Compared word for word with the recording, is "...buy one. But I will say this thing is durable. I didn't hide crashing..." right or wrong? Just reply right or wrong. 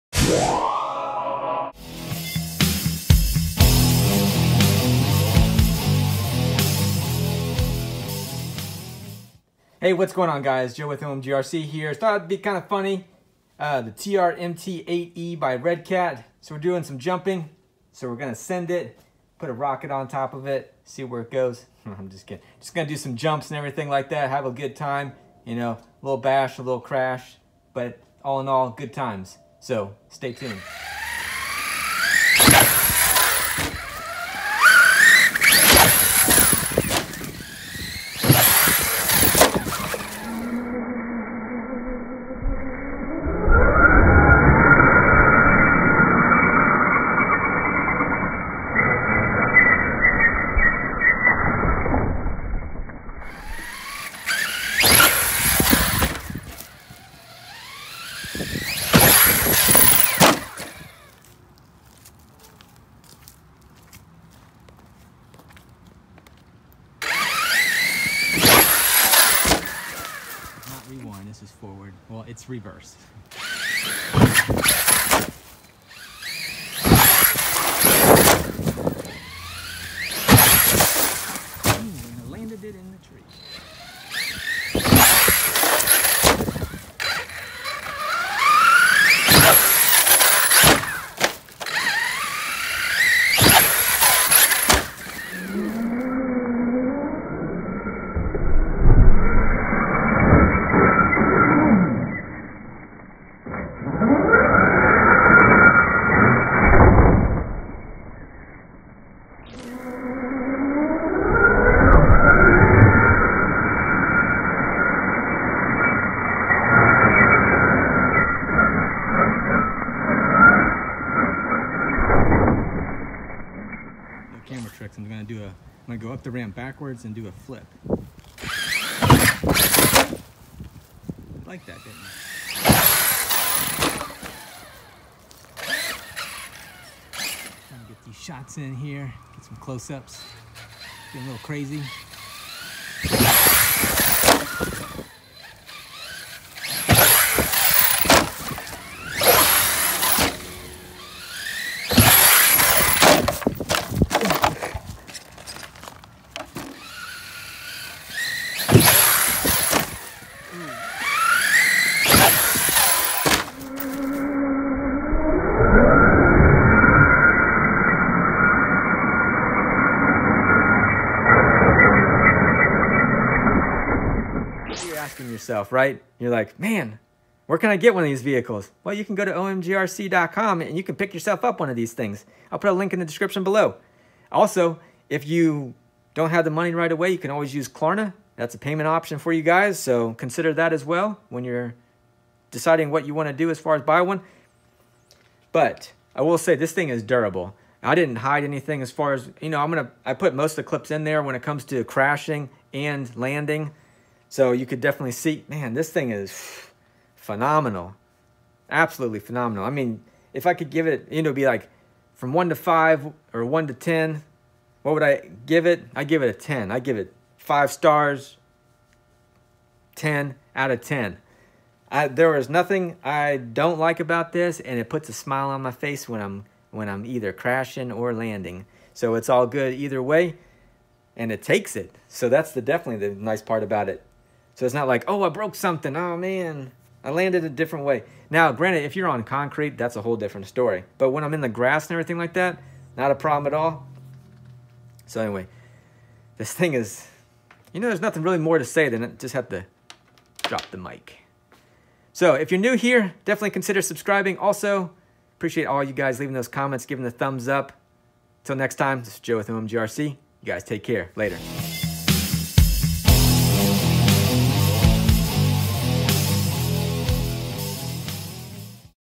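wrong.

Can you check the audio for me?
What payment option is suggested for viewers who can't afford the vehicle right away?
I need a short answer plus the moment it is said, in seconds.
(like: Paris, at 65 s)
Klarna, at 187 s.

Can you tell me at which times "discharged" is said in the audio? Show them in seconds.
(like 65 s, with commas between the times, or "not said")
not said.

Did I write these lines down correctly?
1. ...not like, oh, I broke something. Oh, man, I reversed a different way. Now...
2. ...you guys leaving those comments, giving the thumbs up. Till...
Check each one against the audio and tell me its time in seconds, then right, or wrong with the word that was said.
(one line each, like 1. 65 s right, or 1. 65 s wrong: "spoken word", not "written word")
1. 234 s wrong: "landed", not "reversed"
2. 255 s right.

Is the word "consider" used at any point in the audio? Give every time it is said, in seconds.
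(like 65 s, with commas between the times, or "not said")
190 s, 253 s.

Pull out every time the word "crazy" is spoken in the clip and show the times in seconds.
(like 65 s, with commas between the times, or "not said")
141 s.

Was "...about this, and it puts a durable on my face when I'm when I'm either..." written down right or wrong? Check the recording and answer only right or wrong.
wrong.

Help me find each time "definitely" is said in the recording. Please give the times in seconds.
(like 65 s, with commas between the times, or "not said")
204 s, 232 s, 253 s.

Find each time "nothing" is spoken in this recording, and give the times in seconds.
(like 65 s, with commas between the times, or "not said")
222 s, 248 s.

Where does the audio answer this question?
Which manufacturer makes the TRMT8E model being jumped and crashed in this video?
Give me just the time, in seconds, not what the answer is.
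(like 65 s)
15 s.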